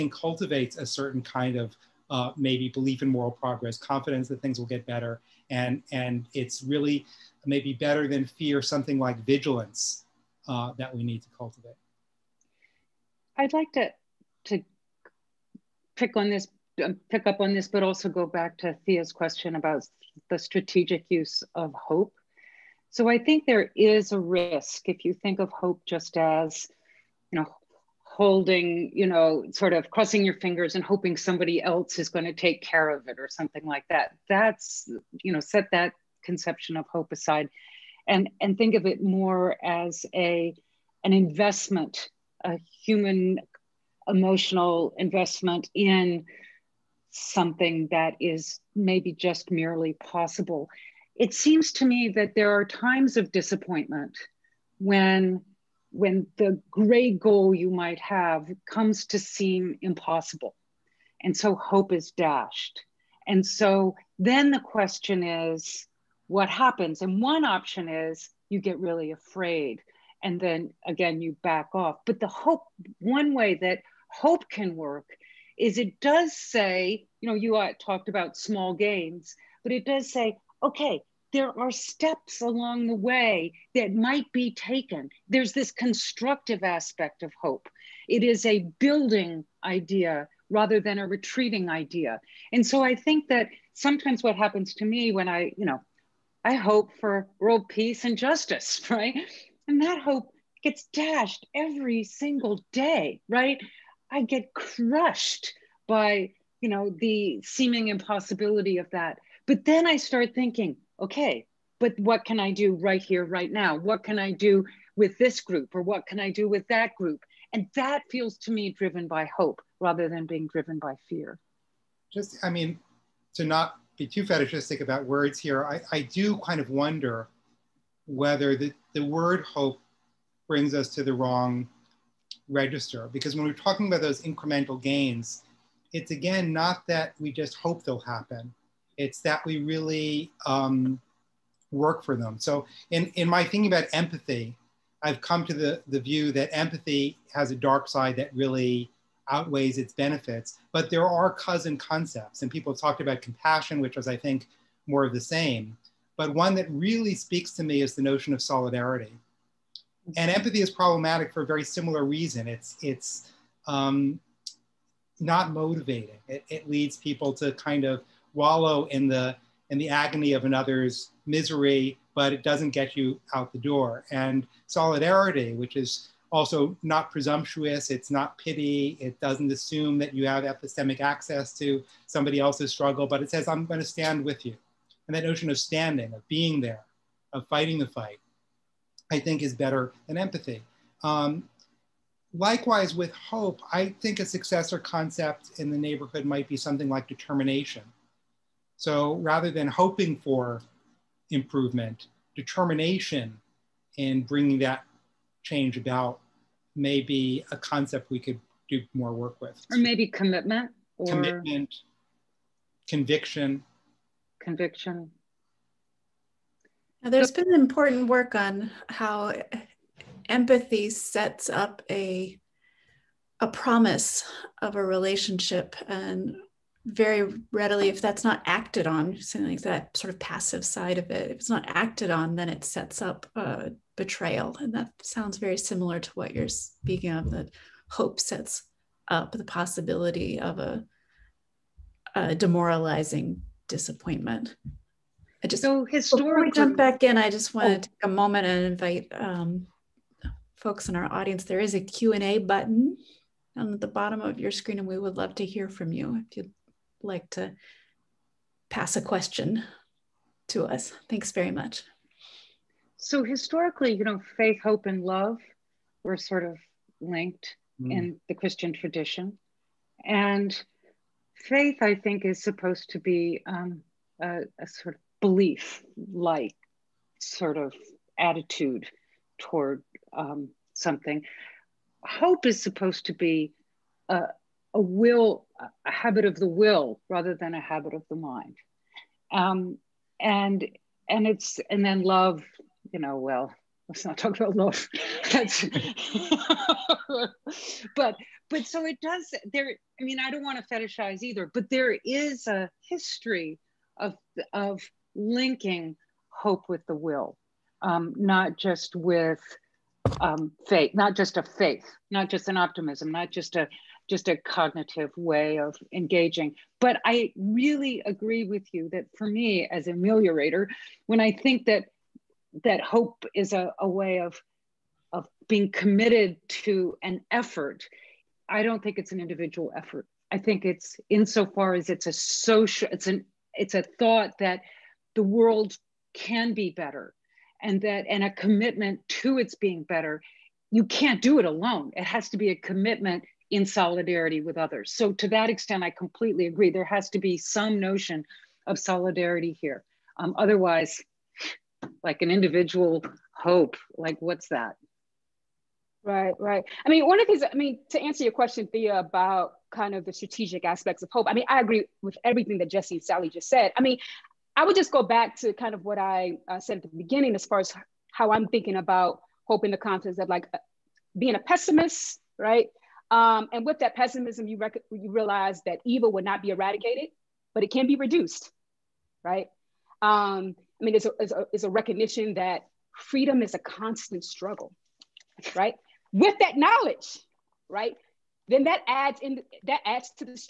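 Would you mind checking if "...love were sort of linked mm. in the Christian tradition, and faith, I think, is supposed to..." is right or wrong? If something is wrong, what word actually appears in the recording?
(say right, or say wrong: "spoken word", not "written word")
right.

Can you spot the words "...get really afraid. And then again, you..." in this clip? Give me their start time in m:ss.
1:08.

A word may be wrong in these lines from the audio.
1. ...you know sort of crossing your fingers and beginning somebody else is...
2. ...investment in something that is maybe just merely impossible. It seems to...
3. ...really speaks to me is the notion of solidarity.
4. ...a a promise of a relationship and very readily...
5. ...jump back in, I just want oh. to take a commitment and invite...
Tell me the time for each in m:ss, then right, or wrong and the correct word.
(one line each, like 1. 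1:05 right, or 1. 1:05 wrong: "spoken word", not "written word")
1. 0:28 wrong: "hoping", not "beginning"
2. 0:44 wrong: "possible", not "impossible"
3. 2:36 right
4. 3:41 right
5. 4:06 wrong: "moment", not "commitment".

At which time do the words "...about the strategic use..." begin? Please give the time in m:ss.
0:19.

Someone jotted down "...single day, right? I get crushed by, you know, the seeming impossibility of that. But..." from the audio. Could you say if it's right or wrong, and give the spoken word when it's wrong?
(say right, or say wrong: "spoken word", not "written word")
right.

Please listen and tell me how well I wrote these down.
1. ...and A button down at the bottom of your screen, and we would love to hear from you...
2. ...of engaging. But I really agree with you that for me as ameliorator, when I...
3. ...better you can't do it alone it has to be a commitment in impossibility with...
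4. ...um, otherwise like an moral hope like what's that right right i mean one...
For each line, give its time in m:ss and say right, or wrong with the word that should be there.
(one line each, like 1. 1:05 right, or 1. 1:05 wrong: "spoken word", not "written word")
1. 4:12 right
2. 5:15 right
3. 5:39 wrong: "solidarity", not "impossibility"
4. 5:50 wrong: "individual", not "moral".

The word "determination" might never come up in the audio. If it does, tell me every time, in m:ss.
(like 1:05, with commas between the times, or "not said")
3:17, 3:22.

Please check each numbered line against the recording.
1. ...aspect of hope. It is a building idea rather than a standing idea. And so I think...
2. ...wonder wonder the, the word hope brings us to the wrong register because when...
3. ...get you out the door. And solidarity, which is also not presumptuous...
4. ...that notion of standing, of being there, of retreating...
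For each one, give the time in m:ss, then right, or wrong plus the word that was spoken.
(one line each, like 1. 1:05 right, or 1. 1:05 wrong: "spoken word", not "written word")
1. 1:26 wrong: "retreating", not "standing"
2. 2:06 wrong: "whether", not "wonder"
3. 2:52 right
4. 3:05 wrong: "fighting", not "retreating".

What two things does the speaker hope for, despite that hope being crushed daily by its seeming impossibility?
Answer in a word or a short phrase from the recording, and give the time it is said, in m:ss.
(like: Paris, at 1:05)
World peace and justice, at 1:37.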